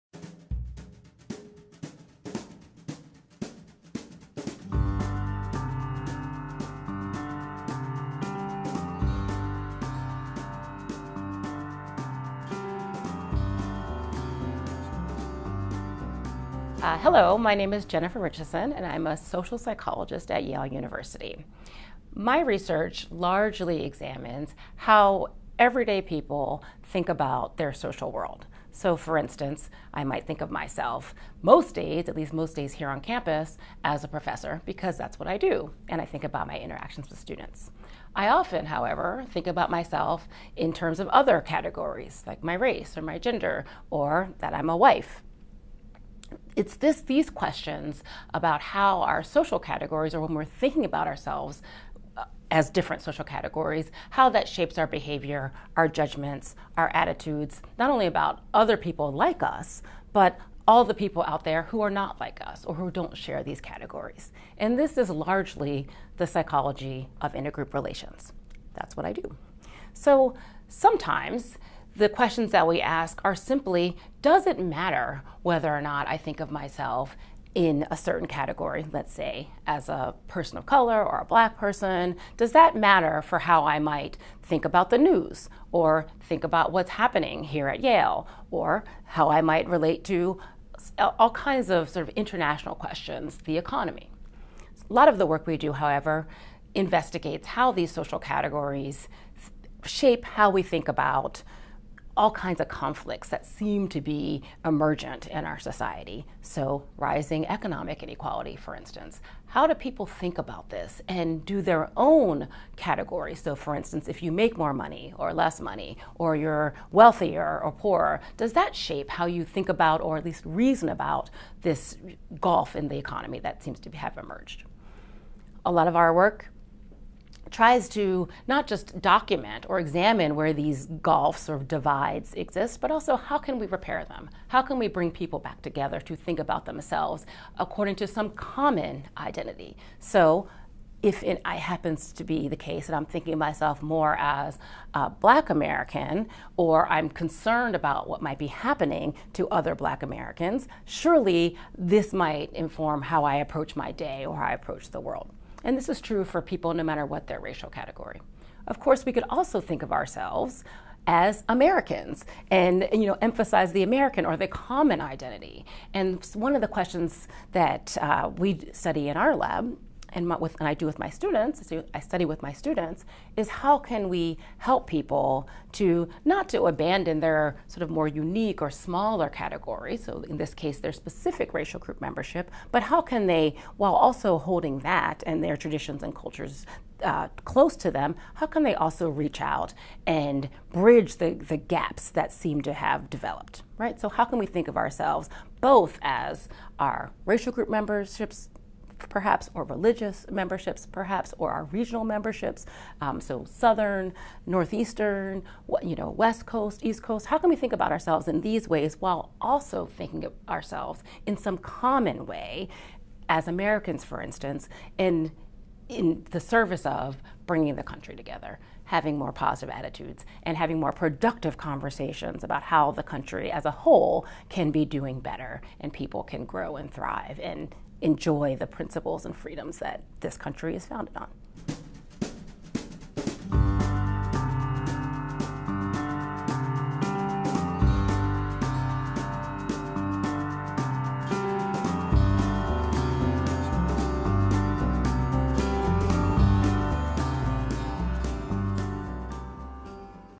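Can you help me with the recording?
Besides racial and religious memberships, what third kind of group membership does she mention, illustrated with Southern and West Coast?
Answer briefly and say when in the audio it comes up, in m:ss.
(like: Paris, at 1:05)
regional memberships, at 3:21.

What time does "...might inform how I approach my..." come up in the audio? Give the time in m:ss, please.
2:32.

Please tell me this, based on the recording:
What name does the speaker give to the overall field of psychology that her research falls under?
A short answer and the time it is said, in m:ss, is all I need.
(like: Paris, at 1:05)
intergroup relations, at 1:06.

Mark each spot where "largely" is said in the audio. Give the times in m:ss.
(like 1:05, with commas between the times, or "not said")
0:23, 1:05.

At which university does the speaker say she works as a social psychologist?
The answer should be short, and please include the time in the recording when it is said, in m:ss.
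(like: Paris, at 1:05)
Yale University, at 0:20.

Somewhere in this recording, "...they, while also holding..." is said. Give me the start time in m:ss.
3:03.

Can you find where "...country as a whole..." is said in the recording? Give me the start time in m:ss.
3:43.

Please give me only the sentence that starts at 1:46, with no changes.
So, rising economic inequality, for instance.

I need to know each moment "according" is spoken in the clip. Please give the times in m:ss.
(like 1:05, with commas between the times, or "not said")
2:17.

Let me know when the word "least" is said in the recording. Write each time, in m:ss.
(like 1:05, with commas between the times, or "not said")
0:32, 2:00.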